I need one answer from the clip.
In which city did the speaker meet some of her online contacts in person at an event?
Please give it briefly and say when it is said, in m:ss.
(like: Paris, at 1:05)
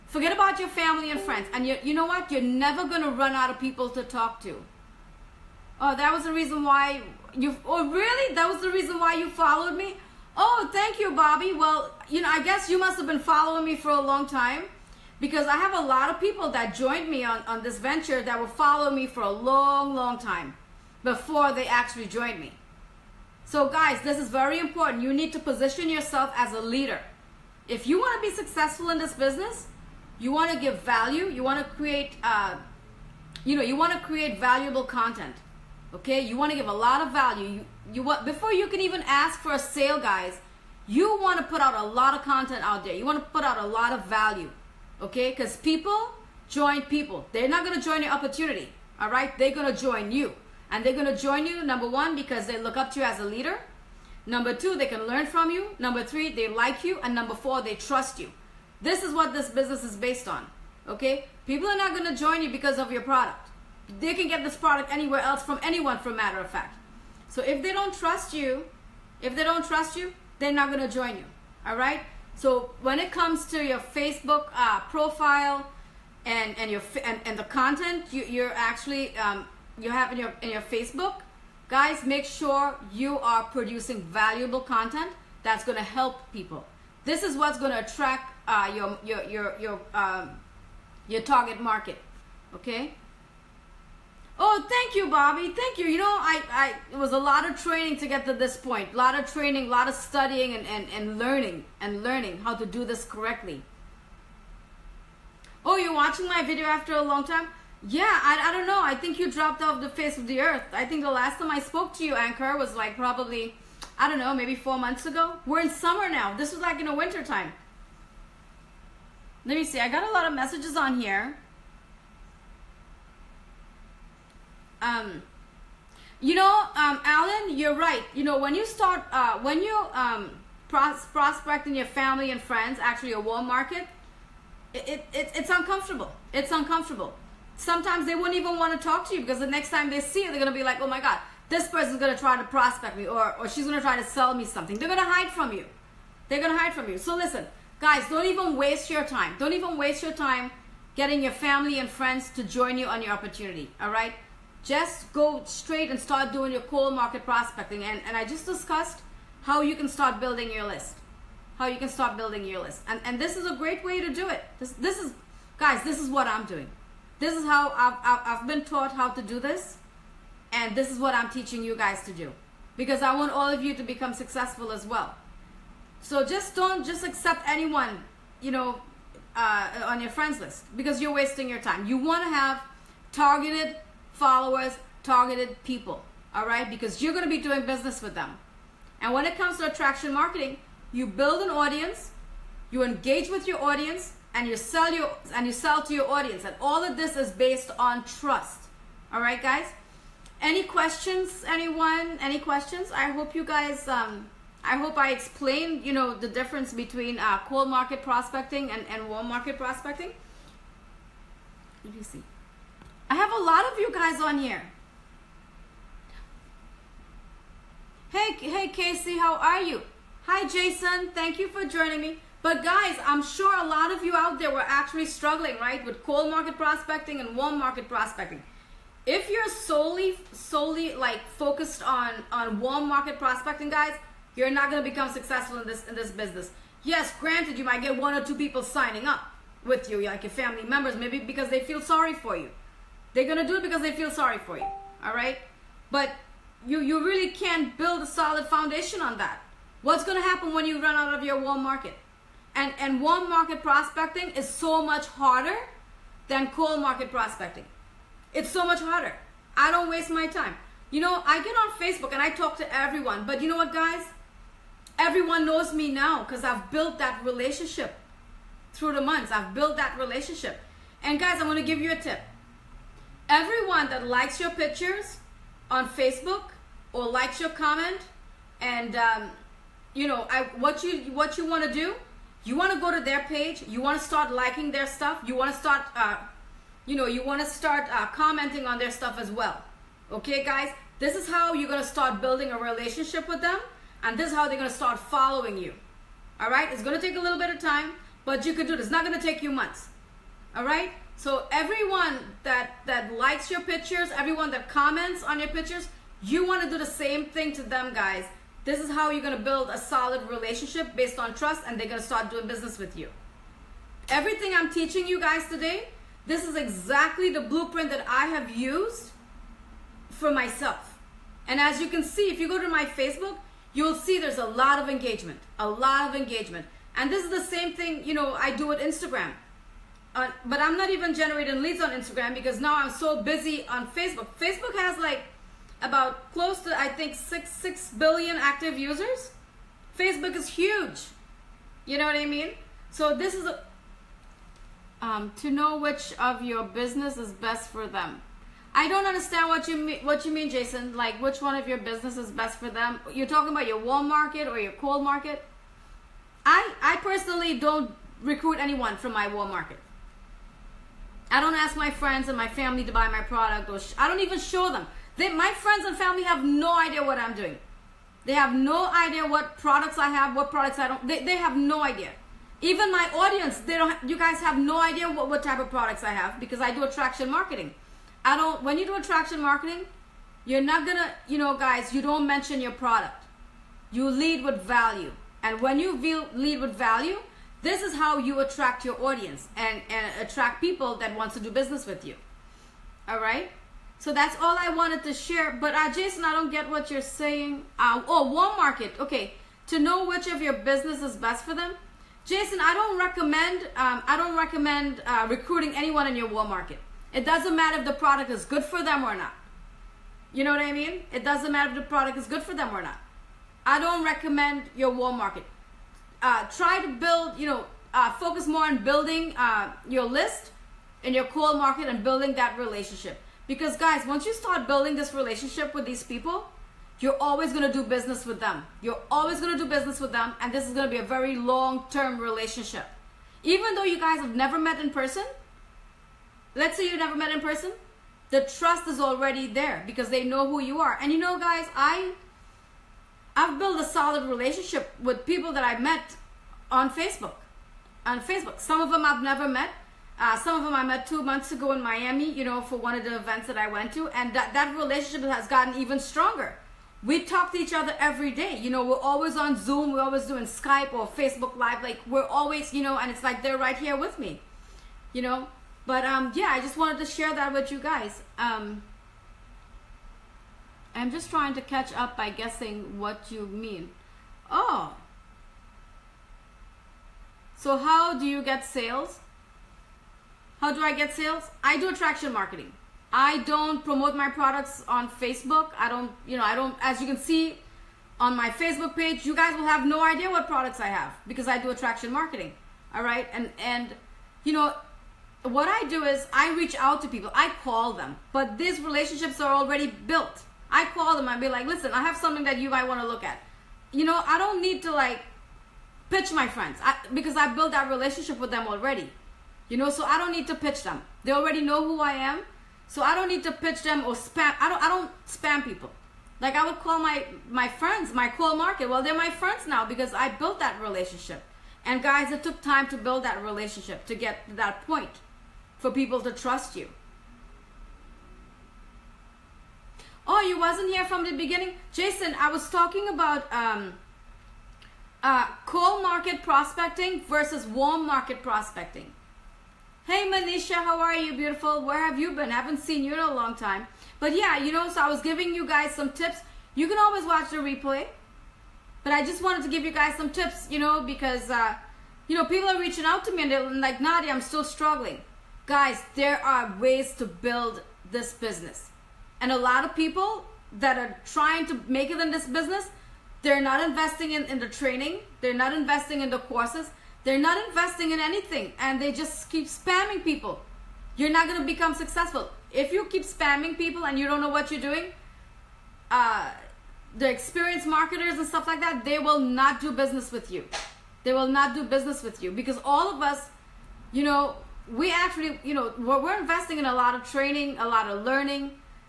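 Miami, at 7:31.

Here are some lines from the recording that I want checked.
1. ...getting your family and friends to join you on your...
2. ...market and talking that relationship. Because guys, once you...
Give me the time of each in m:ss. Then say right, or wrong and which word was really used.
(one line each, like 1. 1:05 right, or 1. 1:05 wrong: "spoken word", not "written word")
1. 2:30 right
2. 7:01 wrong: "building", not "talking".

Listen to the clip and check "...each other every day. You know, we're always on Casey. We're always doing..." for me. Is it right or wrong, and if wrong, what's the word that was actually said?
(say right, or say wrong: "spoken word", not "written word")
wrong: "Zoom", not "Casey".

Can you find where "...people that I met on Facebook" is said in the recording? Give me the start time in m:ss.
7:25.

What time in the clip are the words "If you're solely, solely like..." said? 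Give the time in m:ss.
3:49.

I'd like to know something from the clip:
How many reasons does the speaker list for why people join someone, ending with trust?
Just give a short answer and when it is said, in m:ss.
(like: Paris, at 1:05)
4, at 0:57.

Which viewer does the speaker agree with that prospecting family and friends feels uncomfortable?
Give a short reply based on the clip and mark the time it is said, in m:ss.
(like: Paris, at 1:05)
Alan, at 2:07.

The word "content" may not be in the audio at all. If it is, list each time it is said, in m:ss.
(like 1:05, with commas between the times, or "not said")
0:34, 0:42, 1:17, 1:24.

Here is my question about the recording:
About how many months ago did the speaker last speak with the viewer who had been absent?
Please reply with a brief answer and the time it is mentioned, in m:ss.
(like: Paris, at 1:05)
4, at 1:54.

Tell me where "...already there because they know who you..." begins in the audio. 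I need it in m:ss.
7:18.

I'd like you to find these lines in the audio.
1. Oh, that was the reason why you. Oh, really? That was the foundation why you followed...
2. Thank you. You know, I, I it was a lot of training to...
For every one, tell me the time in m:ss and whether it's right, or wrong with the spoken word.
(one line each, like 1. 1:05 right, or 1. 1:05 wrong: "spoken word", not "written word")
1. 0:05 wrong: "reason", not "foundation"
2. 1:35 right.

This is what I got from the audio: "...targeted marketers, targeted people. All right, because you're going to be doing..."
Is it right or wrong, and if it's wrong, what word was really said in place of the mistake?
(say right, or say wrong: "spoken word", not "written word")
wrong: "followers", not "marketers".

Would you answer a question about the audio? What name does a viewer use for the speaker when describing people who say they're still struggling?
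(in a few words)
Nadia.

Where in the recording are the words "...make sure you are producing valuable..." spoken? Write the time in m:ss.
1:22.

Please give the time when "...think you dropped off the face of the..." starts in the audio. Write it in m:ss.
1:48.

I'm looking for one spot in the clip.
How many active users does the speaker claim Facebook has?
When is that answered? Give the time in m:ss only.
5:37.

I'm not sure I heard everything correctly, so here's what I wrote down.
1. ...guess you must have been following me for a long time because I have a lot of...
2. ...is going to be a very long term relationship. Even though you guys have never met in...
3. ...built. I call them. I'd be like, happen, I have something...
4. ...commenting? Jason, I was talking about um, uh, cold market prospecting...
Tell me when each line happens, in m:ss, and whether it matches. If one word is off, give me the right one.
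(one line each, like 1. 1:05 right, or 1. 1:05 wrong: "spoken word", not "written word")
1. 0:12 right
2. 7:10 right
3. 8:19 wrong: "listen", not "happen"
4. 8:51 wrong: "beginning", not "commenting".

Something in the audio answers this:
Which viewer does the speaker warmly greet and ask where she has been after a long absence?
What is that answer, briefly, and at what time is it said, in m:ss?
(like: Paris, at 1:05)
Manisha, at 9:00.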